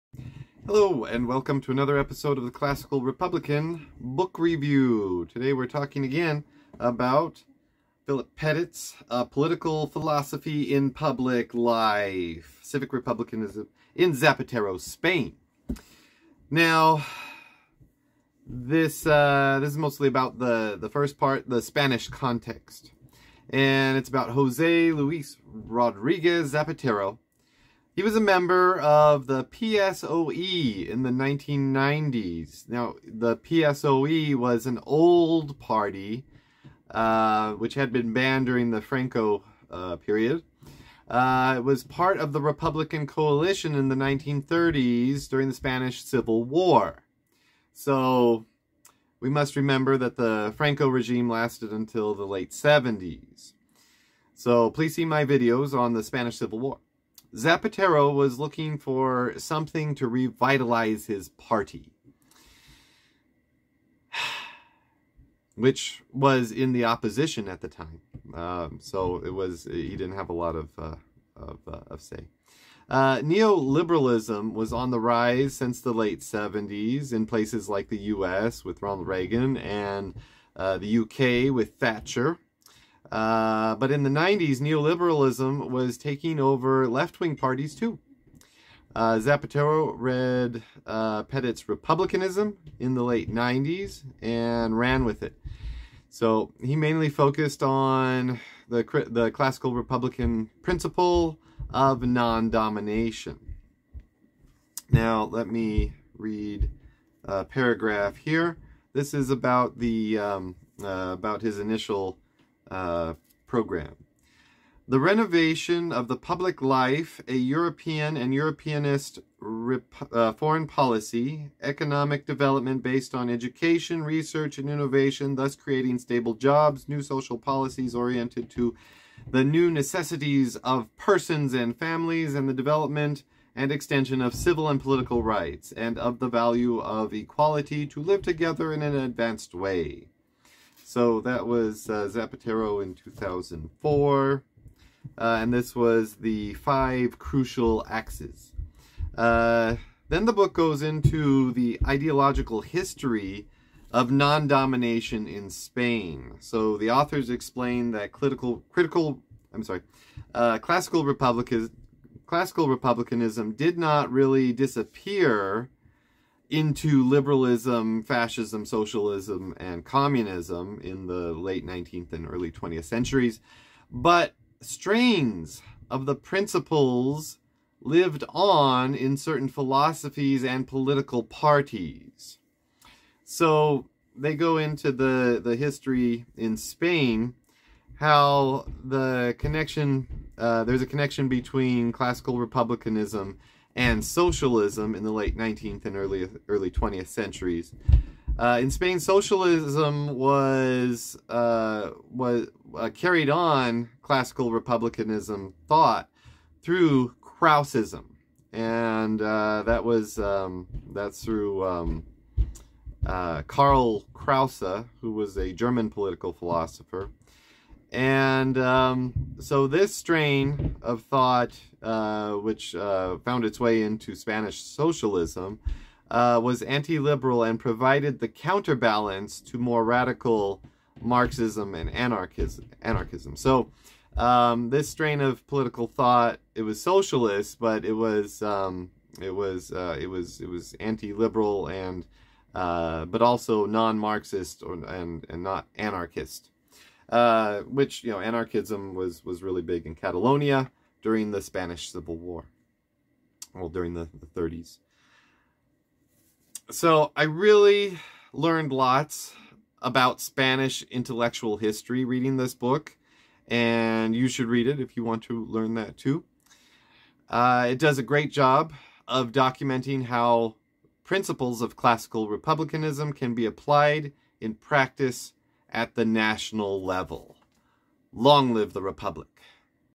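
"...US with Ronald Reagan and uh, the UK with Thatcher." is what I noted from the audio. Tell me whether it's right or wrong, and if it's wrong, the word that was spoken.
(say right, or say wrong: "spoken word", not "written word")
right.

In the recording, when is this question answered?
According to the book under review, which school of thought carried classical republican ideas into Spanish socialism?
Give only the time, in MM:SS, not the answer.
03:27.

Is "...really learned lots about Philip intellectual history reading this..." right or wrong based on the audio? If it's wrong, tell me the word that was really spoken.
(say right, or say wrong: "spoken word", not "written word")
wrong: "Spanish", not "Philip".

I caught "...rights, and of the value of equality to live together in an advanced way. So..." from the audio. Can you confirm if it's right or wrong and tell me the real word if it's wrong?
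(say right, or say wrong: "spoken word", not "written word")
right.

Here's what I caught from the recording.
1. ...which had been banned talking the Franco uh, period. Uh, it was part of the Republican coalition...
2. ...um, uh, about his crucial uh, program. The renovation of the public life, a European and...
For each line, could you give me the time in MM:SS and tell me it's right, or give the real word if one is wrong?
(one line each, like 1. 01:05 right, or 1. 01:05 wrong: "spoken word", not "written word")
1. 00:37 wrong: "during", not "talking"
2. 01:50 wrong: "initial", not "crucial".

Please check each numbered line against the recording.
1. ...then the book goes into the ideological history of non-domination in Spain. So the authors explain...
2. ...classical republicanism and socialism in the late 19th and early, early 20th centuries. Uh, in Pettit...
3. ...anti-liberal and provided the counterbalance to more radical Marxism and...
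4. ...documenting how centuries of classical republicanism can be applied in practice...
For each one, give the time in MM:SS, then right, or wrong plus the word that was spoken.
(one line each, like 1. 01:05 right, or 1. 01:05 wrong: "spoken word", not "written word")
1. 02:30 right
2. 03:11 wrong: "Spain", not "Pettit"
3. 03:46 right
4. 04:29 wrong: "principles", not "centuries".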